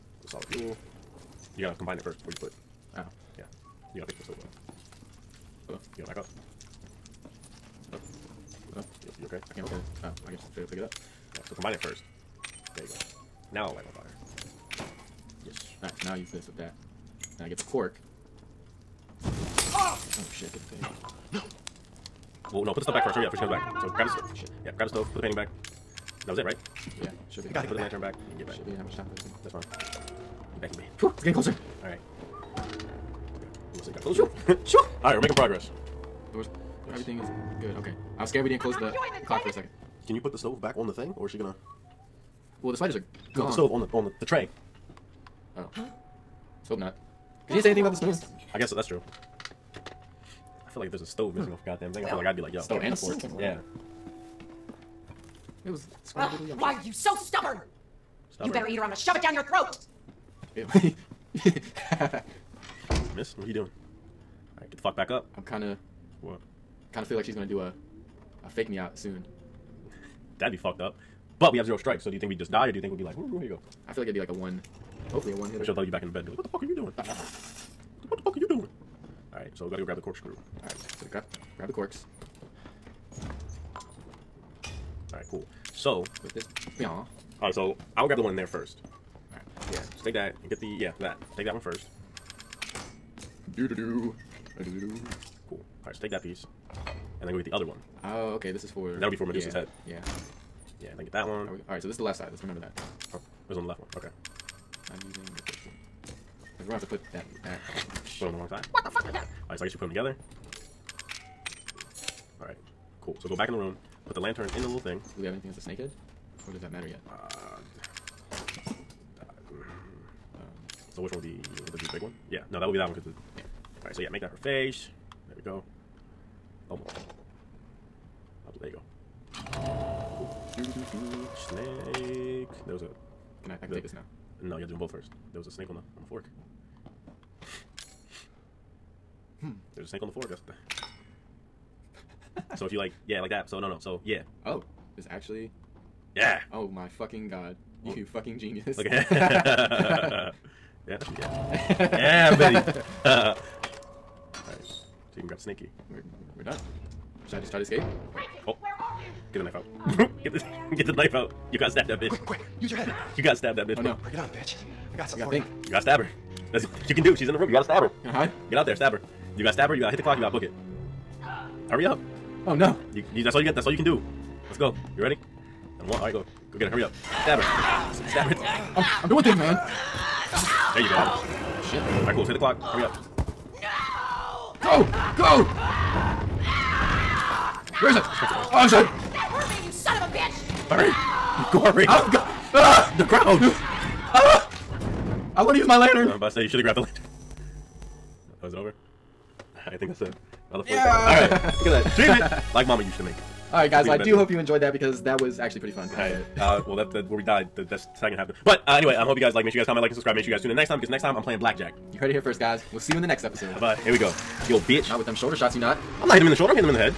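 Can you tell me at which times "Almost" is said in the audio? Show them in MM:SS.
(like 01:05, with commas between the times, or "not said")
02:06.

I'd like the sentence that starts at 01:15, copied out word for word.
She'll throw you back in the bed and be like, what the fuck are you doing?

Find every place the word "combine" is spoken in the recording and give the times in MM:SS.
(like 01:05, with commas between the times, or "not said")
00:01, 00:11.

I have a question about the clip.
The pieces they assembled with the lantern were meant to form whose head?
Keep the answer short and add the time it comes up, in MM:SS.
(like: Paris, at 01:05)
Medusa, at 01:39.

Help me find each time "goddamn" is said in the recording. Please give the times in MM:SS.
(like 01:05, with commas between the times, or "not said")
00:51.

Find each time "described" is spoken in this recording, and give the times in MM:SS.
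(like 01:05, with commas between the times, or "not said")
not said.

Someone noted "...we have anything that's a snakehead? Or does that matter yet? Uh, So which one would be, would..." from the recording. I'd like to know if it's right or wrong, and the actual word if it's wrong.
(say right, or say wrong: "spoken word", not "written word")
right.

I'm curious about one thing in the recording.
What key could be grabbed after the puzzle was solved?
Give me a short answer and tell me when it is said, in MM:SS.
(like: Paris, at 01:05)
snake key, at 02:35.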